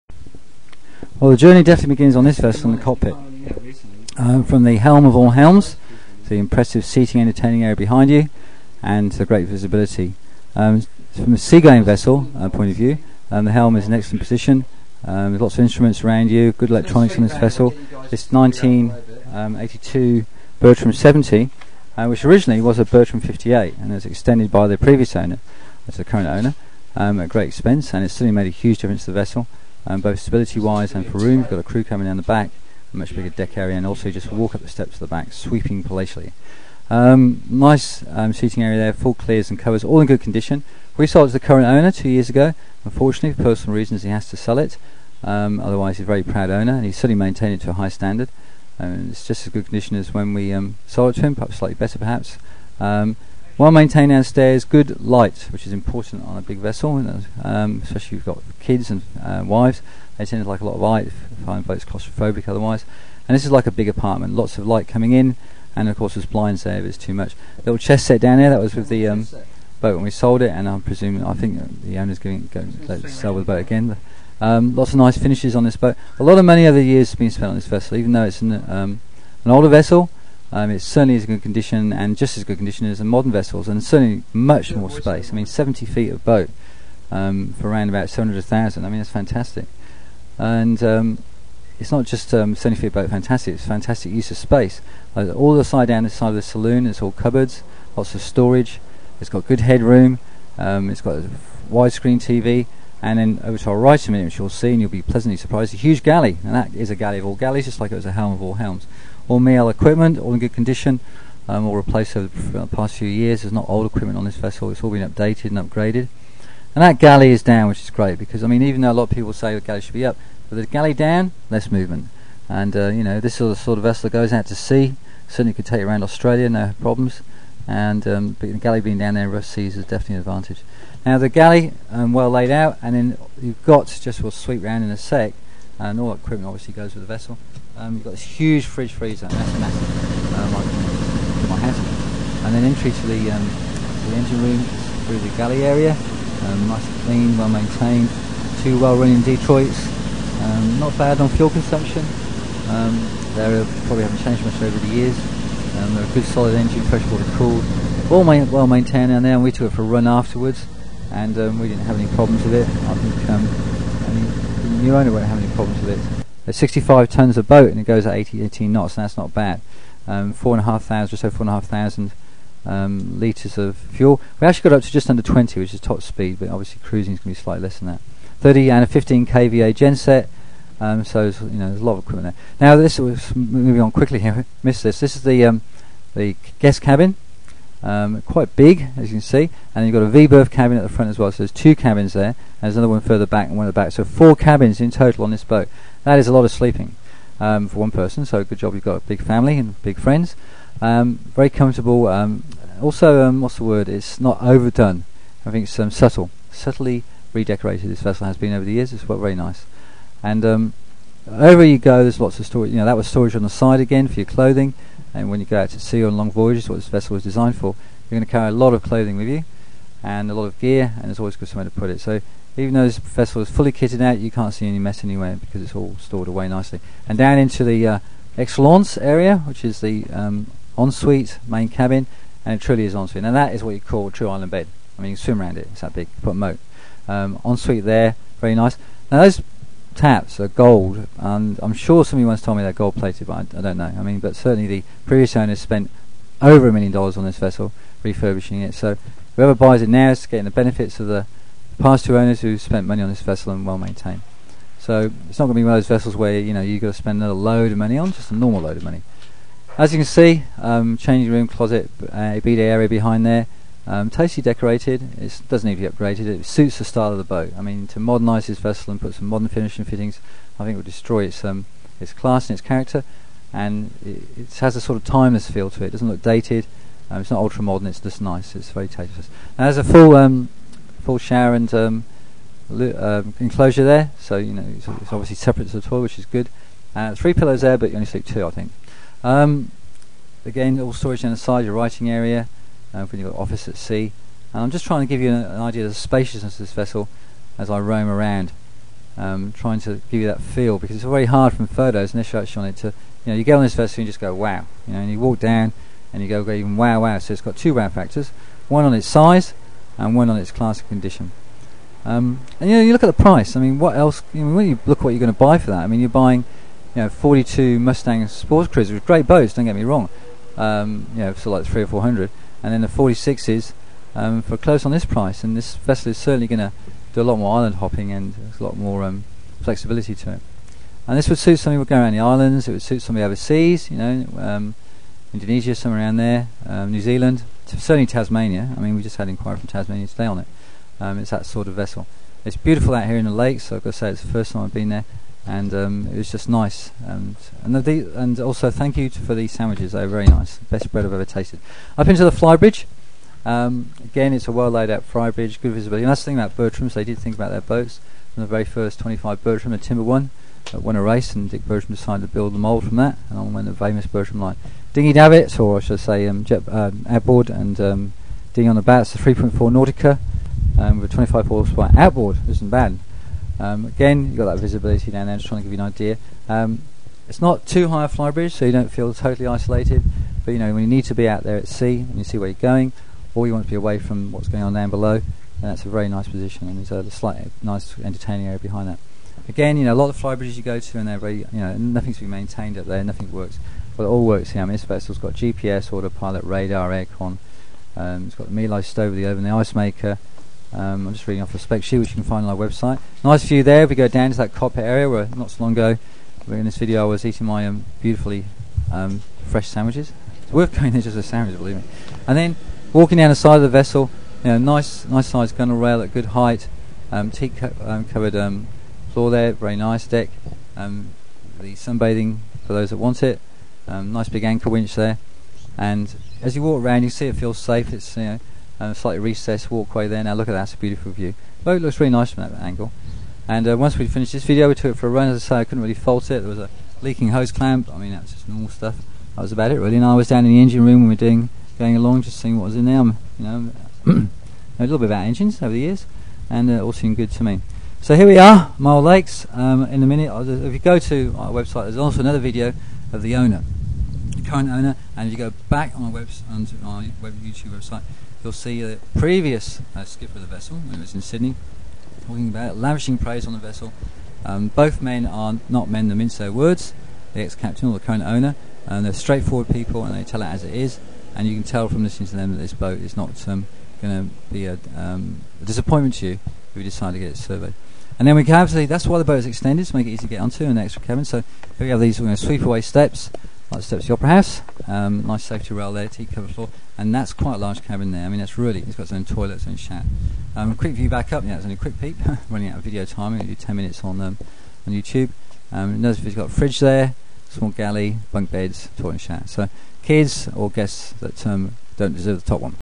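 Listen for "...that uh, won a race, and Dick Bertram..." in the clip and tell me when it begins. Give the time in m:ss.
6:00.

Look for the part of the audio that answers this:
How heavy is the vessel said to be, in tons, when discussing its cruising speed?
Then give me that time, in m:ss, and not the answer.
2:46.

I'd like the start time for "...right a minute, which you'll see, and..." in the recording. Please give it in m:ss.
1:43.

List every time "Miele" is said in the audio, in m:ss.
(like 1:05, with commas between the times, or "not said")
1:49, 6:38.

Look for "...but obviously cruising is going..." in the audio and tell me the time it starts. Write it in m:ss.
2:56.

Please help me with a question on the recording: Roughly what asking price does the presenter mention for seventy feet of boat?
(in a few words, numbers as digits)
700,000.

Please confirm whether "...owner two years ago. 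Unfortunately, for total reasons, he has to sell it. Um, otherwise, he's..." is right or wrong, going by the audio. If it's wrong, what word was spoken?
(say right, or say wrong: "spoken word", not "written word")
wrong: "personal", not "total".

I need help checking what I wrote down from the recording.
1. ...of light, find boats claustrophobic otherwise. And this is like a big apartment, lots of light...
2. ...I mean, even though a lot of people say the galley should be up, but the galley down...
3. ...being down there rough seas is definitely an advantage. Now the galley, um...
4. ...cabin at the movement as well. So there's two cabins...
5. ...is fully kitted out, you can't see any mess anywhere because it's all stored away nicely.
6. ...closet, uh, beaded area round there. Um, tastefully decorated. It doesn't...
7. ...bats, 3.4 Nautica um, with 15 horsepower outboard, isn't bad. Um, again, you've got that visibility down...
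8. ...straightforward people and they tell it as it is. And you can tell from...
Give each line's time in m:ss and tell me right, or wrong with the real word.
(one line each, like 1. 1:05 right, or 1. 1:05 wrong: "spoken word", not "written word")
1. 1:00 right
2. 1:58 right
3. 2:08 right
4. 3:10 wrong: "front", not "movement"
5. 3:43 right
6. 4:21 wrong: "behind", not "round"
7. 6:08 wrong: "25", not "15"
8. 7:49 right.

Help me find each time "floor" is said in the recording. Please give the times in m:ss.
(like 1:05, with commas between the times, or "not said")
6:59, 8:06.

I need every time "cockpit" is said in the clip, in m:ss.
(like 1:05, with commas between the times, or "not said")
0:02, 6:44.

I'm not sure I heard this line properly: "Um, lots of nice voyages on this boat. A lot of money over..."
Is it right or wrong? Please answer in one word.
wrong.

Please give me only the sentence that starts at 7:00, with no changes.
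the sunbathing for those that want it.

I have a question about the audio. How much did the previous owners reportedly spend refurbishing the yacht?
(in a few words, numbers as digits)
over a million dollars.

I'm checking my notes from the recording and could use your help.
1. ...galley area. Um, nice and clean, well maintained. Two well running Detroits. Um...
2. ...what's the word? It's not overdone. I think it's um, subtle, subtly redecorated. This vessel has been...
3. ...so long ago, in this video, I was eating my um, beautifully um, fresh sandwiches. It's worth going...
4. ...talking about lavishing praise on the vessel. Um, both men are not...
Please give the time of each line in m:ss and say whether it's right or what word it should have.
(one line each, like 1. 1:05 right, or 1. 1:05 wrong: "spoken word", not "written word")
1. 2:25 right
2. 3:23 right
3. 6:45 right
4. 7:42 right.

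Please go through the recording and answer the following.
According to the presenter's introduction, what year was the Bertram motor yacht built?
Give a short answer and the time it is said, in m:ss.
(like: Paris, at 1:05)
1982, at 0:18.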